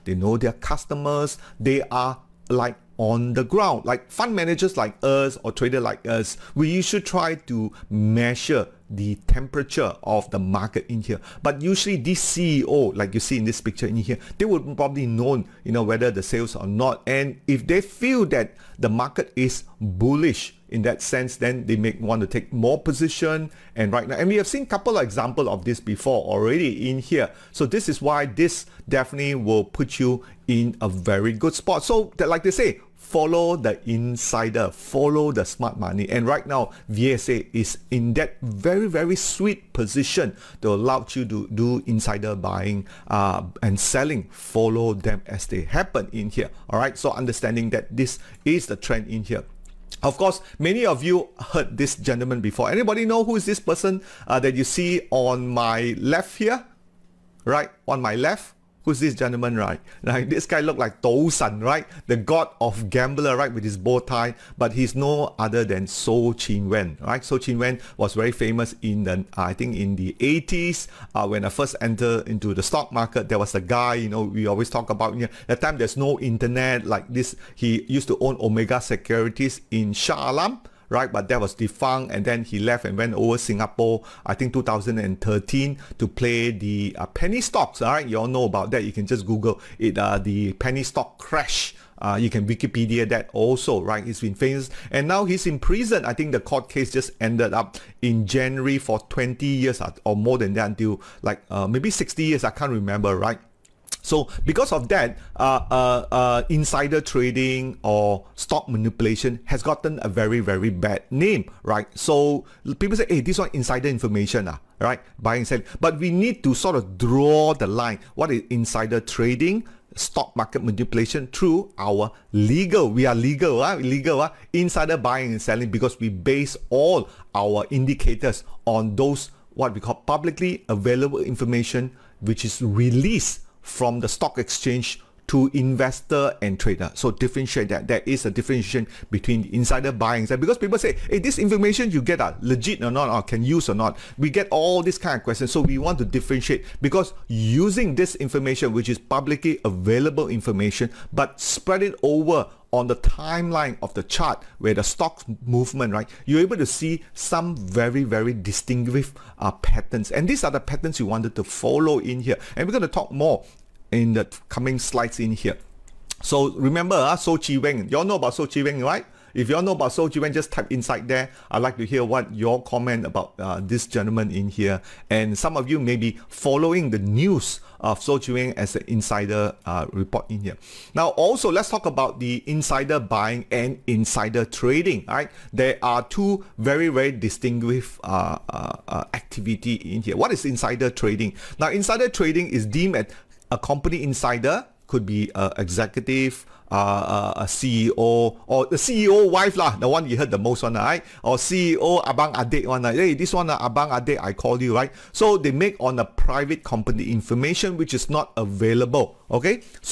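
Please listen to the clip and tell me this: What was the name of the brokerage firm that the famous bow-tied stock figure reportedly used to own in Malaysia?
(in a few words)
Omega Securities.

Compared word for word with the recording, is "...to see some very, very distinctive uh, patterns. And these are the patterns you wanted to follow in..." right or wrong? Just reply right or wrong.
right.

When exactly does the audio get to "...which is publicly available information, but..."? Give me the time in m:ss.
2:28.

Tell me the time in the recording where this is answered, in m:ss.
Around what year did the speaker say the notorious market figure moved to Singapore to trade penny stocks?
1:24.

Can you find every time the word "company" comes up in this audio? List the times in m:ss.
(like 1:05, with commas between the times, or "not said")
3:13, 3:26.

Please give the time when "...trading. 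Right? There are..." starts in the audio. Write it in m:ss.
3:04.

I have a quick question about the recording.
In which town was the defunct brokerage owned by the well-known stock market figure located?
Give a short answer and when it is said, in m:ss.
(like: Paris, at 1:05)
Shah Alam, at 1:19.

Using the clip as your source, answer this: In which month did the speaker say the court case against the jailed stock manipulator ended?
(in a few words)
January.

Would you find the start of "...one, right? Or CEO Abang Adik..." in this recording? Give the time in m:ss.
3:20.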